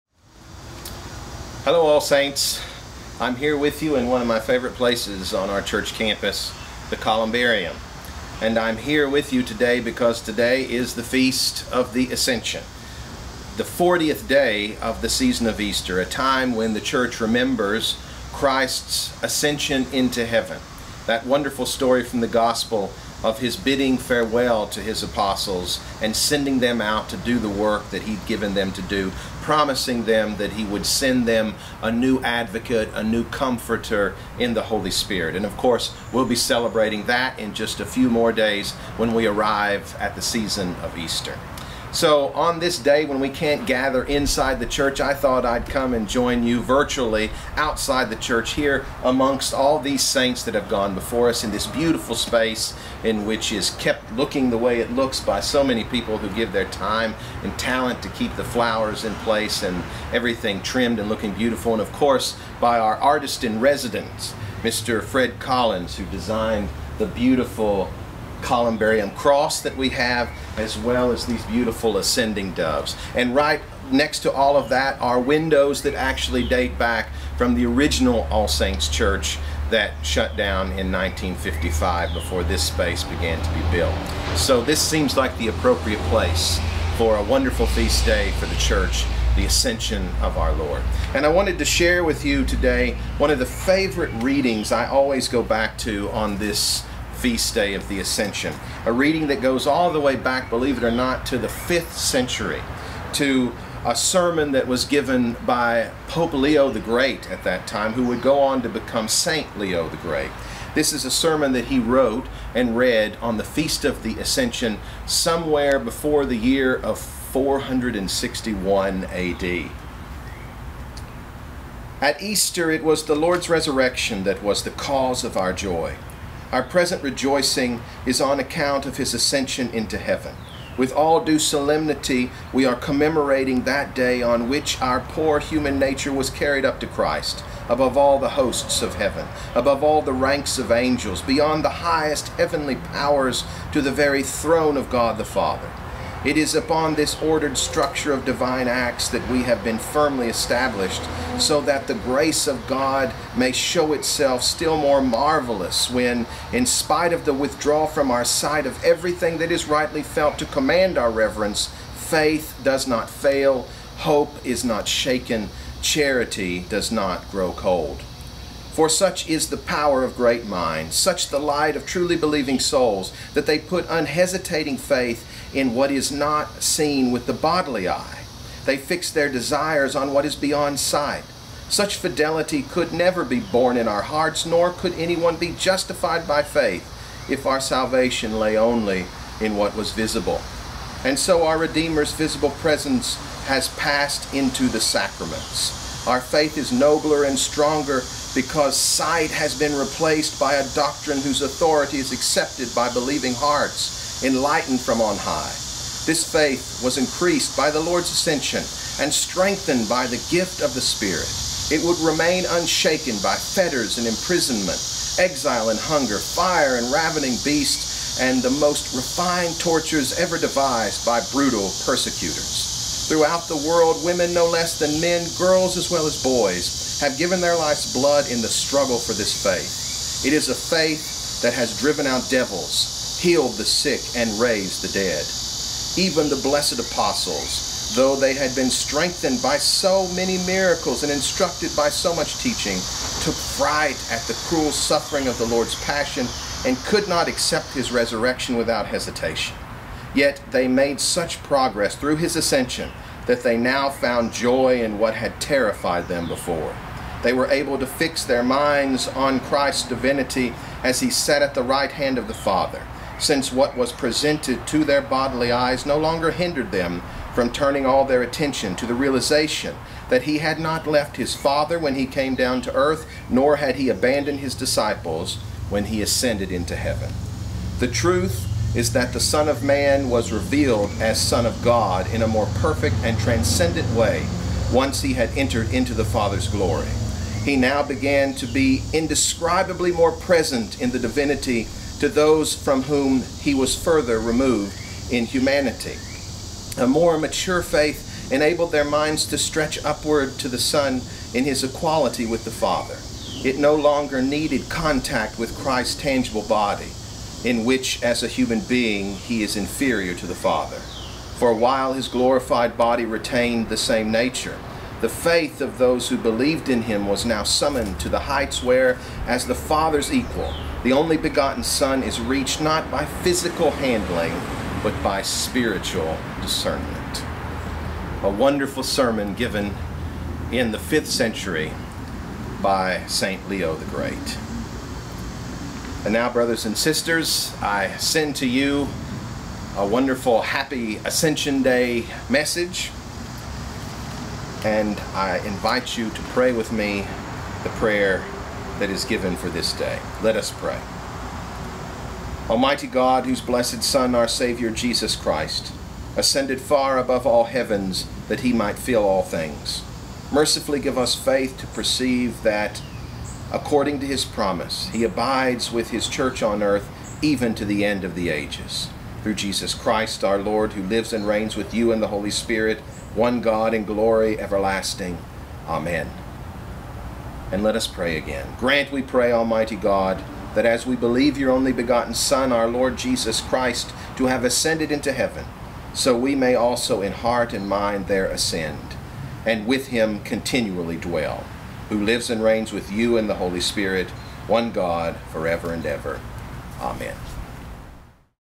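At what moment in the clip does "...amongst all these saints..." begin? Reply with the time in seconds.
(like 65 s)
49 s.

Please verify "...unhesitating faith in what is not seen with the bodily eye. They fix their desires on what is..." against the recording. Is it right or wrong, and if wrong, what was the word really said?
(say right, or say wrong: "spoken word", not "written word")
right.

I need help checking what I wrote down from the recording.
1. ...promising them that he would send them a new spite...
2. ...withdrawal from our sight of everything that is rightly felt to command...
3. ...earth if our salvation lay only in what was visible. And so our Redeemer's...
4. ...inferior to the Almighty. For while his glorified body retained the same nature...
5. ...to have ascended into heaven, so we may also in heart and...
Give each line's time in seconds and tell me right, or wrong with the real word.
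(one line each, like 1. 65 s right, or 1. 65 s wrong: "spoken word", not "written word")
1. 29 s wrong: "advocate", not "spite"
2. 157 s right
3. 186 s wrong: "faith", not "earth"
4. 309 s wrong: "Father", not "Almighty"
5. 384 s right.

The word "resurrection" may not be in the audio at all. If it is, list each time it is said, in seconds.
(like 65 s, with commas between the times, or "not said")
123 s, 247 s.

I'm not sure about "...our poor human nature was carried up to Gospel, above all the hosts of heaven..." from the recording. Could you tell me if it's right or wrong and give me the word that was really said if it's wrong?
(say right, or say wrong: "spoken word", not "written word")
wrong: "Christ", not "Gospel".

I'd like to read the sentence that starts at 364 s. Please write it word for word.
He abides with his church on earth even to the end of the ages.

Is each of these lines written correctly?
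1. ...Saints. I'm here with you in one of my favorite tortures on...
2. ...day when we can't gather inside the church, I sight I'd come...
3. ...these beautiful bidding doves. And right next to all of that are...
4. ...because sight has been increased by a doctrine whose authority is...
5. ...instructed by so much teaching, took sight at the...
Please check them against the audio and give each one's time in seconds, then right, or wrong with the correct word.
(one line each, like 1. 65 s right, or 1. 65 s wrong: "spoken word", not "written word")
1. 2 s wrong: "places", not "tortures"
2. 42 s wrong: "thought", not "sight"
3. 71 s wrong: "ascending", not "bidding"
4. 198 s wrong: "replaced", not "increased"
5. 241 s wrong: "fright", not "sight".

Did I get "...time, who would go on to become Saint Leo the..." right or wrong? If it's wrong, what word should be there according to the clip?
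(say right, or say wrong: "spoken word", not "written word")
right.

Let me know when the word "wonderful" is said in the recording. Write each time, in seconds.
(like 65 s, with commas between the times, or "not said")
21 s, 87 s, 328 s, 339 s.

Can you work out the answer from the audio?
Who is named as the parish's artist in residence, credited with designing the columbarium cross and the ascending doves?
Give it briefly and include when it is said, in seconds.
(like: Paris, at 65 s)
Fred Collins, at 64 s.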